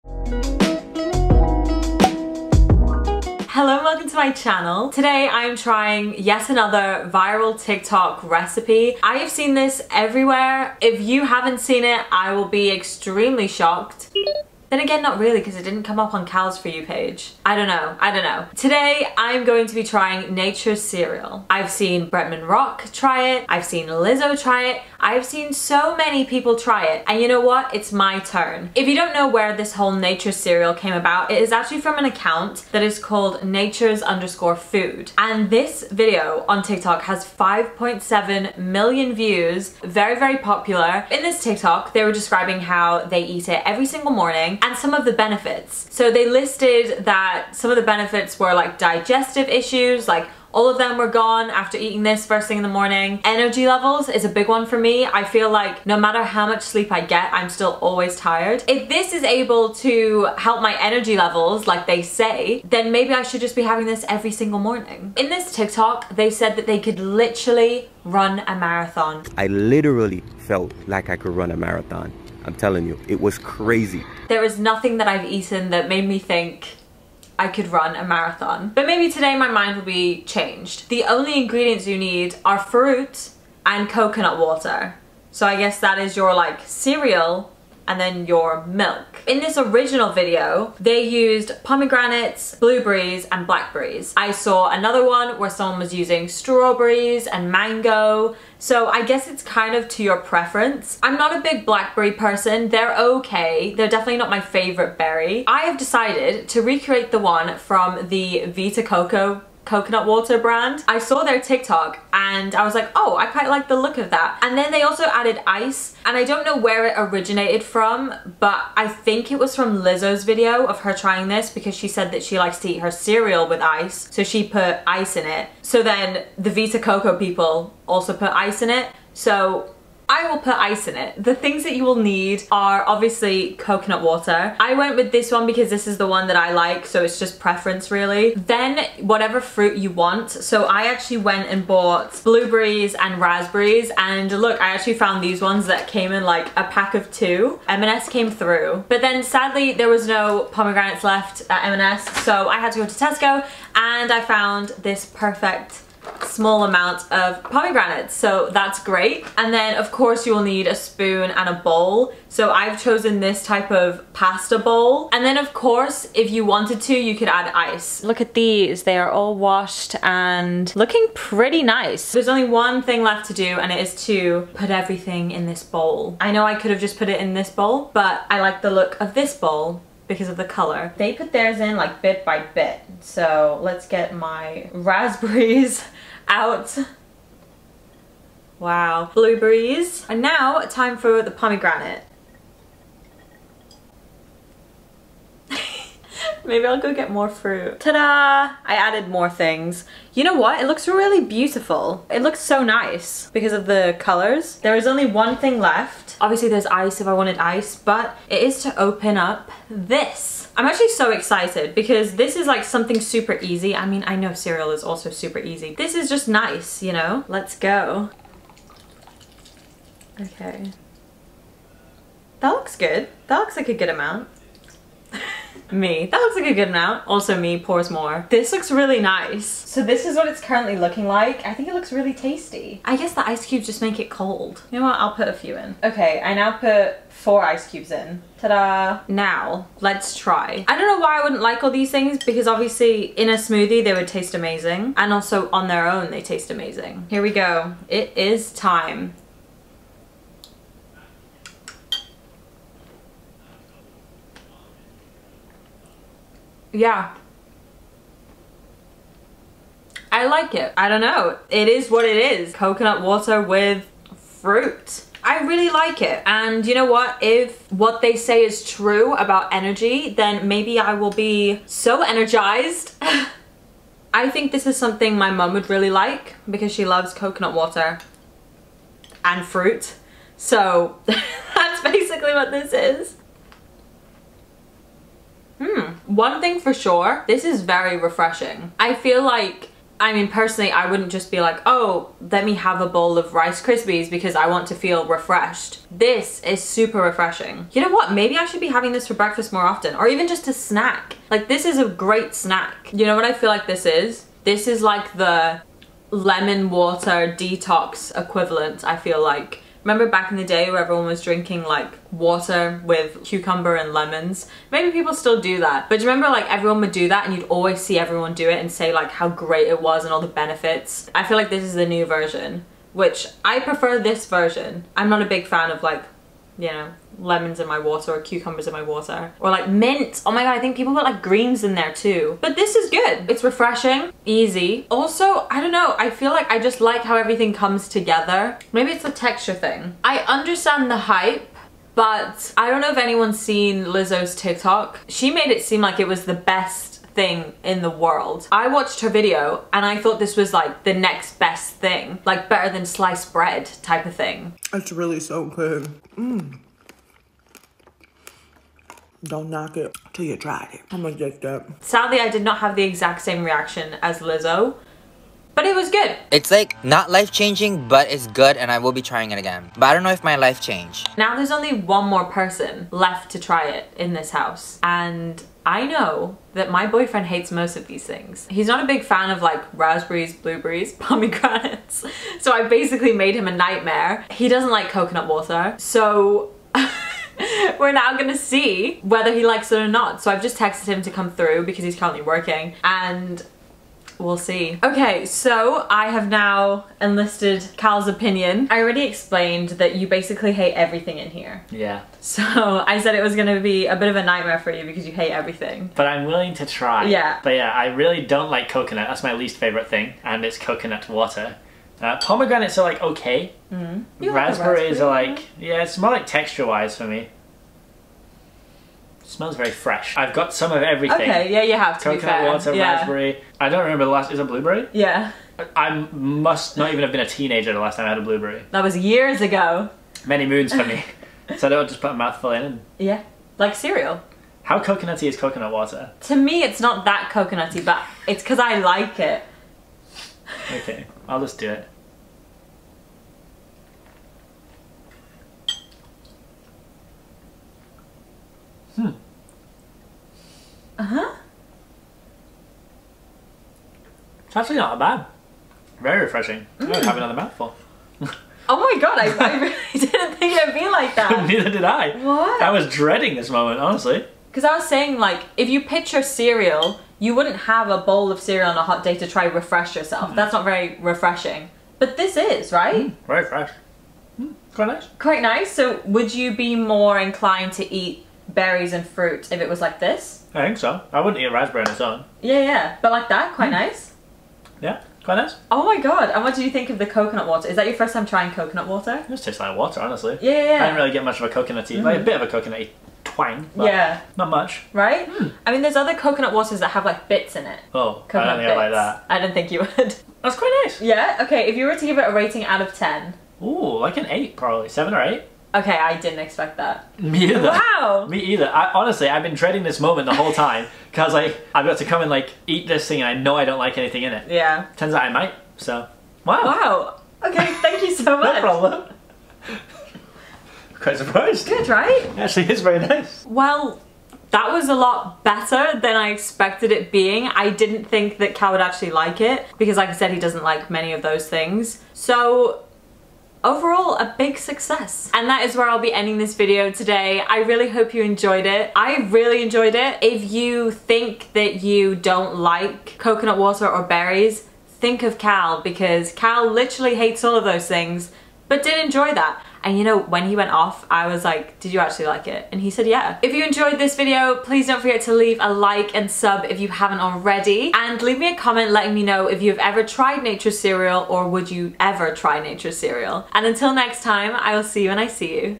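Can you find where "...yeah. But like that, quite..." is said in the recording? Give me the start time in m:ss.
8:02.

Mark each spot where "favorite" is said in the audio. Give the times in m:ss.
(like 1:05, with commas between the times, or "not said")
1:44, 6:49.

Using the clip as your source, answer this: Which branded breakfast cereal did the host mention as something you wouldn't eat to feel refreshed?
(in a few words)
Rice Krispies.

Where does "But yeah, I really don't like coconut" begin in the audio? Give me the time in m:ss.
6:47.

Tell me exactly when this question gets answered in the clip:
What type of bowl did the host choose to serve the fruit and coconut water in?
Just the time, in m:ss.
2:44.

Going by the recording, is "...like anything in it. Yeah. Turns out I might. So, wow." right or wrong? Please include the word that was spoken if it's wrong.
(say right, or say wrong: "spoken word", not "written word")
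right.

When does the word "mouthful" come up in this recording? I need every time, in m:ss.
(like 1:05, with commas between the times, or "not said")
7:12, 7:37.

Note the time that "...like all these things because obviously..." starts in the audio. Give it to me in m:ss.
4:01.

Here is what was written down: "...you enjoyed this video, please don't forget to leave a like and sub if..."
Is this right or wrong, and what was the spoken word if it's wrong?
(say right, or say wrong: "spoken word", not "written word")
right.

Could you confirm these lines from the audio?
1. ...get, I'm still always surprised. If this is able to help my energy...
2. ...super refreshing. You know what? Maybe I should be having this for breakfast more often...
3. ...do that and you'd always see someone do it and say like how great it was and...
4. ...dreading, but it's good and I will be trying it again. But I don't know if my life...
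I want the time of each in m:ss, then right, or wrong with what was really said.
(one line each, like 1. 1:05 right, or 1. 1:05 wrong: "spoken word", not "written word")
1. 0:56 wrong: "tired", not "surprised"
2. 4:56 right
3. 5:16 wrong: "everyone", not "someone"
4. 6:07 wrong: "changing", not "dreading".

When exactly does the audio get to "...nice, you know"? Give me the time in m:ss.
3:36.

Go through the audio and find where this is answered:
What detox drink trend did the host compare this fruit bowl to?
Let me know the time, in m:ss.
5:06.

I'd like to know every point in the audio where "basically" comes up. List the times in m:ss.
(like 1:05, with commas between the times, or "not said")
4:41, 6:22, 6:40.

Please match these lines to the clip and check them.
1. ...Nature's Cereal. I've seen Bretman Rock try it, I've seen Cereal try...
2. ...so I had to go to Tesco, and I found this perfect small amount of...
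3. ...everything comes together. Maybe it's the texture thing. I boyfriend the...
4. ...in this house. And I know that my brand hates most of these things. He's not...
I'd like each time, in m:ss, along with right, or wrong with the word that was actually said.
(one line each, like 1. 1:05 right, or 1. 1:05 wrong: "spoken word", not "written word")
1. 0:20 wrong: "Lizzo", not "Cereal"
2. 2:32 right
3. 5:37 wrong: "understand", not "boyfriend"
4. 6:13 wrong: "boyfriend", not "brand".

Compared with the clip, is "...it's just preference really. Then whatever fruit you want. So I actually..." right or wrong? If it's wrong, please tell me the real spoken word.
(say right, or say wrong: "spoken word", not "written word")
right.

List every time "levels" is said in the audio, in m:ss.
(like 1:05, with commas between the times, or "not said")
0:53, 1:01.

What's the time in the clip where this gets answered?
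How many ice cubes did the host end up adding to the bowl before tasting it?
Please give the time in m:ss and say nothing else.
3:57.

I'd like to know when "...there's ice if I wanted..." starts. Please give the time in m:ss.
3:26.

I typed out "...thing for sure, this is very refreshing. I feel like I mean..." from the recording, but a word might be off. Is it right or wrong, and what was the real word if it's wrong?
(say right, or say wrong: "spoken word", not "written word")
right.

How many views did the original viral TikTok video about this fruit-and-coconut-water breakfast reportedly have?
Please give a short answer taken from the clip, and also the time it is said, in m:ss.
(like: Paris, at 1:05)
5.7 million, at 0:37.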